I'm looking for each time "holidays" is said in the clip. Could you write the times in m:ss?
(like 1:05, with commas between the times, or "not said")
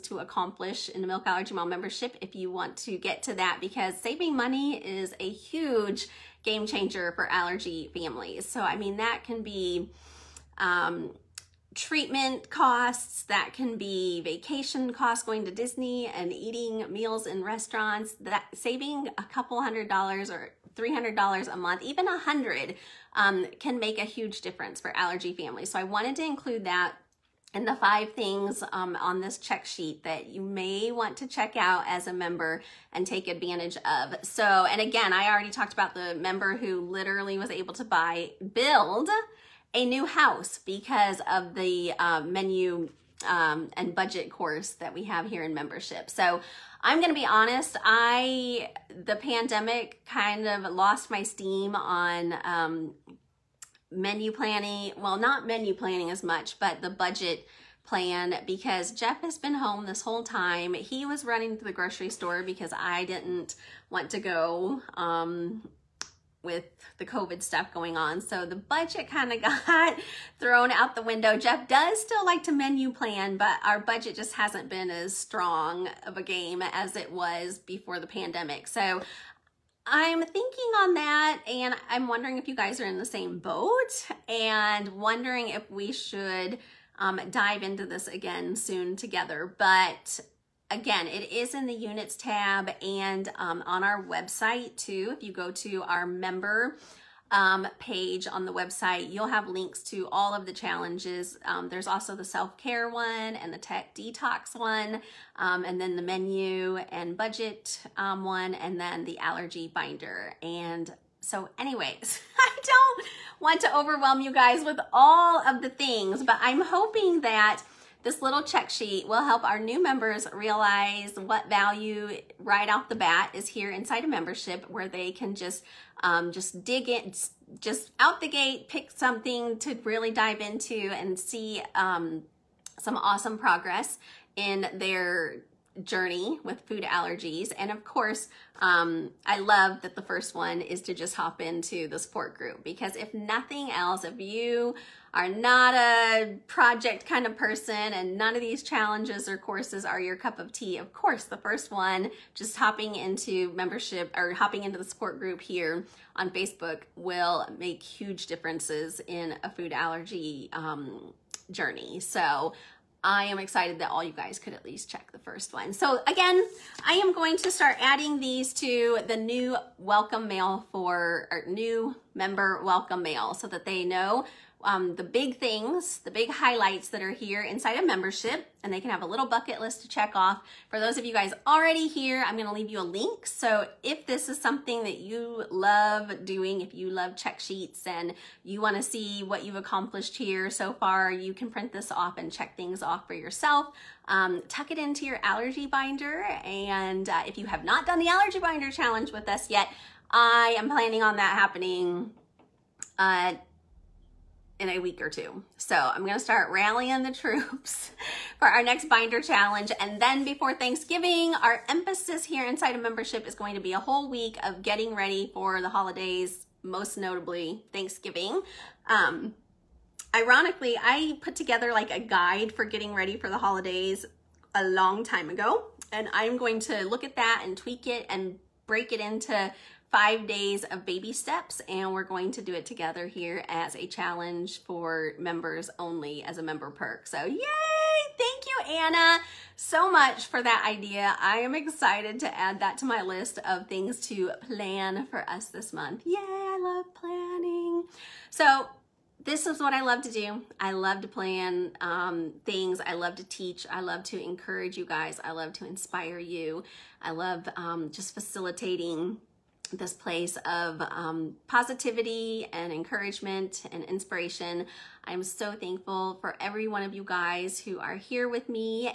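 3:35, 3:43.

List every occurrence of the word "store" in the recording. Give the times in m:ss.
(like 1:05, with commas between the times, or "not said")
1:02.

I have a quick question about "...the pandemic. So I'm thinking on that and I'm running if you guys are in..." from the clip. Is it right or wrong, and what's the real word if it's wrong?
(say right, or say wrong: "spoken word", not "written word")
wrong: "wondering", not "running".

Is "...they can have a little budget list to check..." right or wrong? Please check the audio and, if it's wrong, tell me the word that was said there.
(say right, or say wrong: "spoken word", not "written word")
wrong: "bucket", not "budget".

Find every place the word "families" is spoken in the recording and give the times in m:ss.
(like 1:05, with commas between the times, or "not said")
0:07, 0:25.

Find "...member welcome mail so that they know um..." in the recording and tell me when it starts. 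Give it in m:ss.
2:52.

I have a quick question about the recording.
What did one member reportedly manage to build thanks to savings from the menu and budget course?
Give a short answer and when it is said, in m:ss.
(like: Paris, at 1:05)
A new house, at 0:39.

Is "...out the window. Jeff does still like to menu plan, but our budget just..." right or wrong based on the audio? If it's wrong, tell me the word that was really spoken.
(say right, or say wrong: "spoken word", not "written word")
right.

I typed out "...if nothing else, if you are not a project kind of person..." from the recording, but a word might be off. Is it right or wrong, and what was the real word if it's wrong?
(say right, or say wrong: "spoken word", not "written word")
right.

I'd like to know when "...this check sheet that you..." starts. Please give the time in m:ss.
0:29.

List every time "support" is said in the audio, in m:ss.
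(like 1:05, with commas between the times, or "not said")
2:21, 2:34.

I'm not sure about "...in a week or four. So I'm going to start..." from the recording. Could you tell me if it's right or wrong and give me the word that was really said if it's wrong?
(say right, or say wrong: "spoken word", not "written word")
wrong: "two", not "four".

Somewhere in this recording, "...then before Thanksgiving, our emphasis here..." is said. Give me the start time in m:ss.
3:30.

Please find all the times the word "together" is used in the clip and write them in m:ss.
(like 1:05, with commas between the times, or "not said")
1:28, 3:41, 3:52.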